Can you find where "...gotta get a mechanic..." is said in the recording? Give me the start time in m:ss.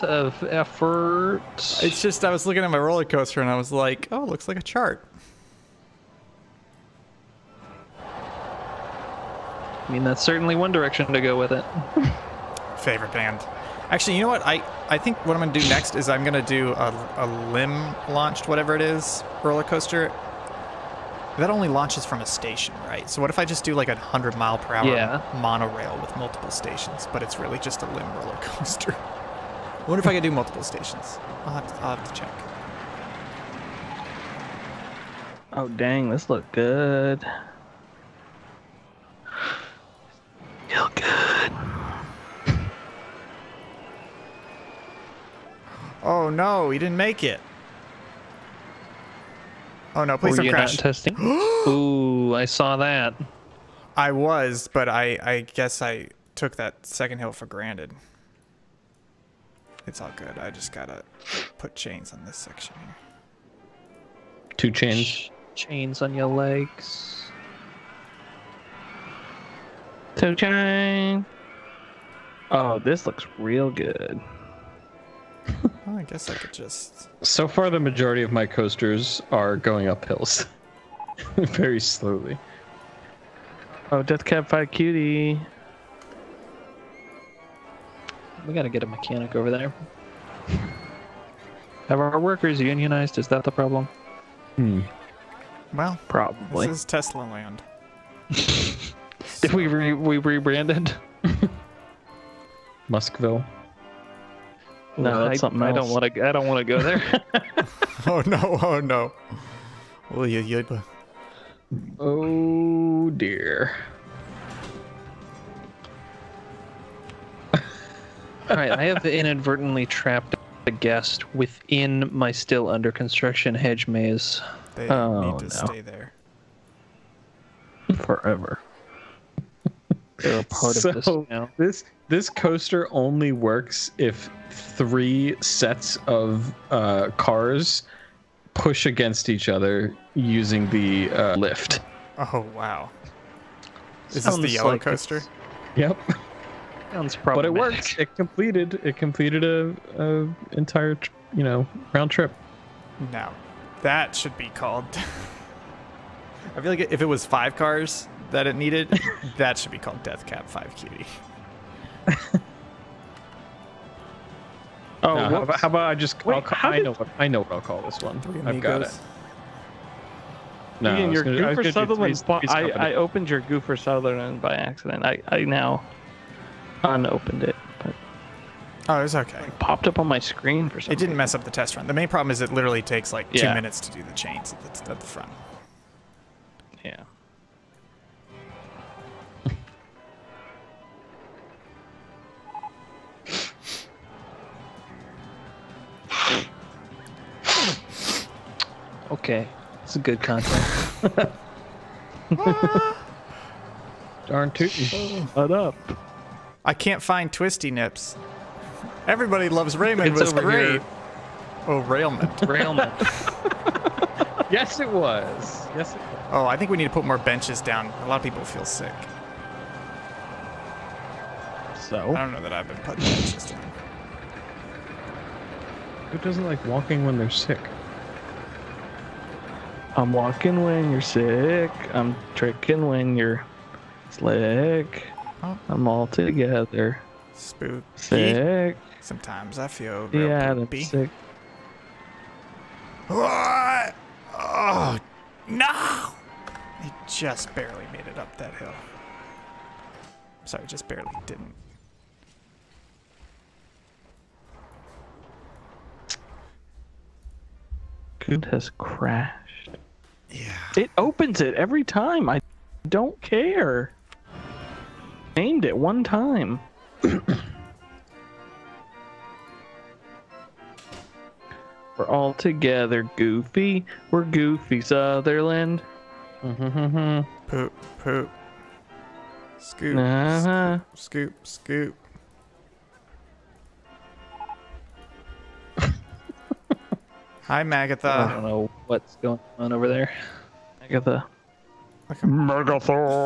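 1:28.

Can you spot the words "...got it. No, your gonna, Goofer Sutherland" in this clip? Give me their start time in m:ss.
2:48.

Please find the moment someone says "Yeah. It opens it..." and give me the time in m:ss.
4:20.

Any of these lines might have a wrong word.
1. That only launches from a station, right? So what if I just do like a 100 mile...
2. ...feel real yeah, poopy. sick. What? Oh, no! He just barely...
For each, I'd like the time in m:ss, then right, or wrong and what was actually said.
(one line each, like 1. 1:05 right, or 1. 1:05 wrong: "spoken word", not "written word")
1. 0:21 right
2. 3:59 right.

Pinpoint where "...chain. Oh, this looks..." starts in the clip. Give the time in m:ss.
1:10.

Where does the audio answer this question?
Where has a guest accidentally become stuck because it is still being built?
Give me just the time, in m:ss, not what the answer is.
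2:03.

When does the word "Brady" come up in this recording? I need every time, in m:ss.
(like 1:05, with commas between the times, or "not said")
not said.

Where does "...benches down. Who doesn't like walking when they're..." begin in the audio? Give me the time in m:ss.
3:43.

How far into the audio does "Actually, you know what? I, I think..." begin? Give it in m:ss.
0:13.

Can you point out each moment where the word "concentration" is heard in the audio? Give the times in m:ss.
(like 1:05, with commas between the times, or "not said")
not said.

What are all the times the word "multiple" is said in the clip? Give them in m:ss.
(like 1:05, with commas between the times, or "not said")
0:26, 0:30.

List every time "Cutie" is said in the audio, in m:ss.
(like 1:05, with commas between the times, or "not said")
1:24, 2:40.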